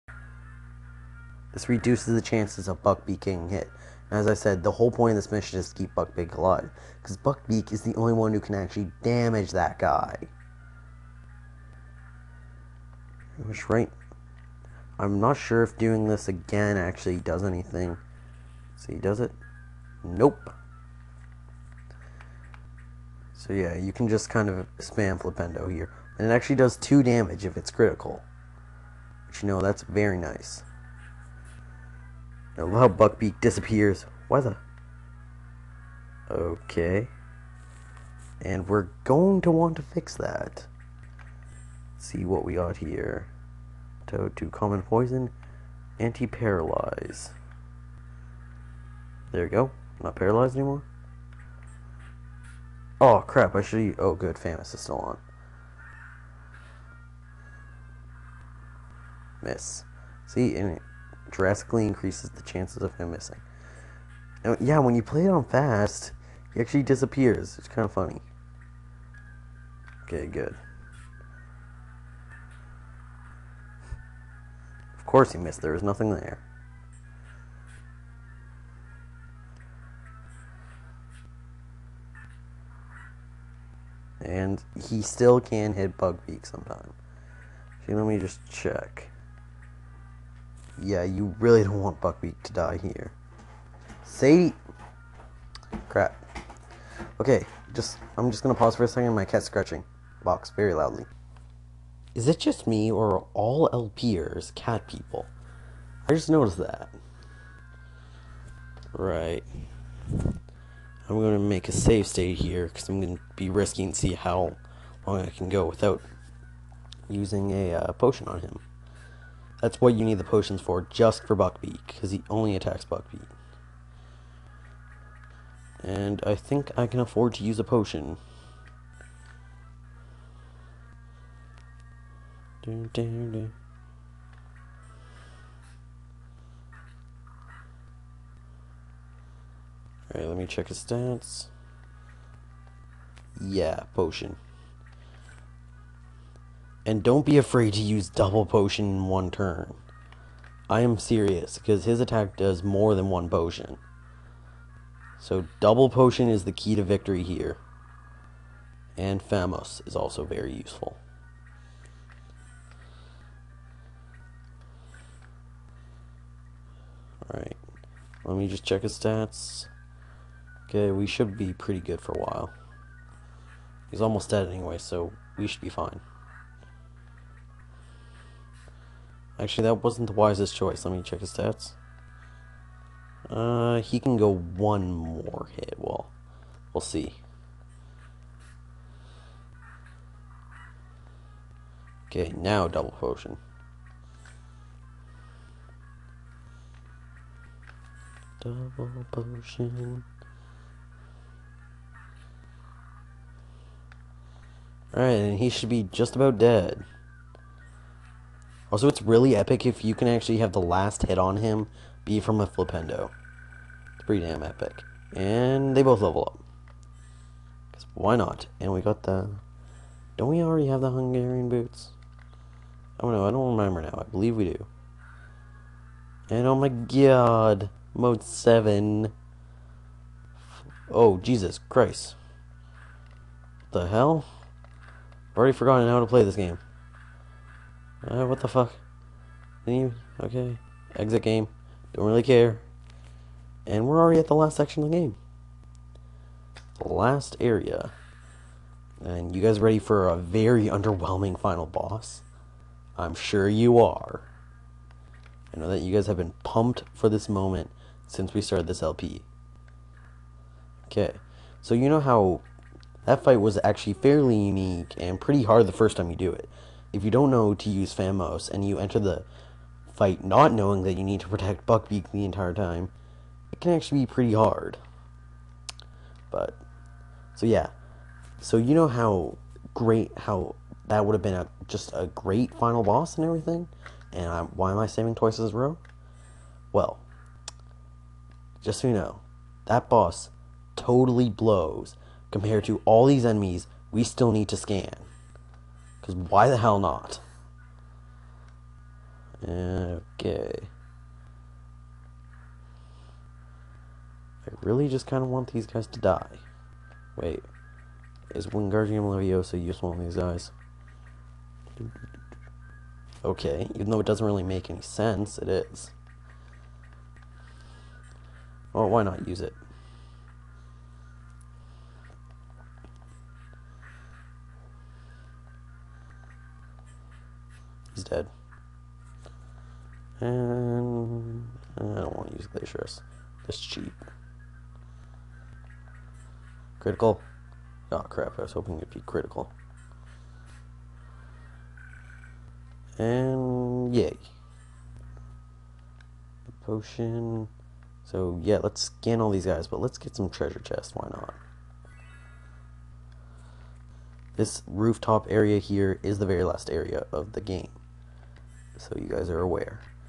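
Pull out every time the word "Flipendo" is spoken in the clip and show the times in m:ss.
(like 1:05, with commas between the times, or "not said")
0:25, 3:32.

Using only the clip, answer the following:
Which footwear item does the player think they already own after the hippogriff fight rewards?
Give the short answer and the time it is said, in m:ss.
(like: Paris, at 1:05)
Hungarian boots, at 3:40.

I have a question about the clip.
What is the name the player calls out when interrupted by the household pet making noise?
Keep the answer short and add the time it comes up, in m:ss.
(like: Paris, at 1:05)
Sadie, at 1:34.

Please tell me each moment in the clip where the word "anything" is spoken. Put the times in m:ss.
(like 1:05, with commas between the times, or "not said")
0:17.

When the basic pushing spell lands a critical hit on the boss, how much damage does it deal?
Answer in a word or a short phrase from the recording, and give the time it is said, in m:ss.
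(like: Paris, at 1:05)
2, at 0:26.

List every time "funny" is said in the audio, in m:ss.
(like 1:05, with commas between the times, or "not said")
1:07.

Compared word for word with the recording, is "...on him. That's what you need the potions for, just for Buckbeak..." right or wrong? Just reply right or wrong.
right.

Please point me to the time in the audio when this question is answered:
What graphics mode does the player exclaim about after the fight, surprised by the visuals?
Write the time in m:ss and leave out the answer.
3:47.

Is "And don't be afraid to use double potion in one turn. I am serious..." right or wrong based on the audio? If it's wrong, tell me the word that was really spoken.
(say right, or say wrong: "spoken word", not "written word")
right.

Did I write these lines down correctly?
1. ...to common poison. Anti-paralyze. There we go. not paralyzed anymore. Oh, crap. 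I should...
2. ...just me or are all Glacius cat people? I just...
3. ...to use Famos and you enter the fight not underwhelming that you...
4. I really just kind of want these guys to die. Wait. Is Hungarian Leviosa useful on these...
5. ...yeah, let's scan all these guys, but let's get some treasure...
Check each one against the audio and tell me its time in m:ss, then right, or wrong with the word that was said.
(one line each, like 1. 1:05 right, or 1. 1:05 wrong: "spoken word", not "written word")
1. 0:44 right
2. 1:42 wrong: "LPers", not "Glacius"
3. 4:27 wrong: "knowing", not "underwhelming"
4. 5:04 wrong: "Wingardium", not "Hungarian"
5. 5:48 right.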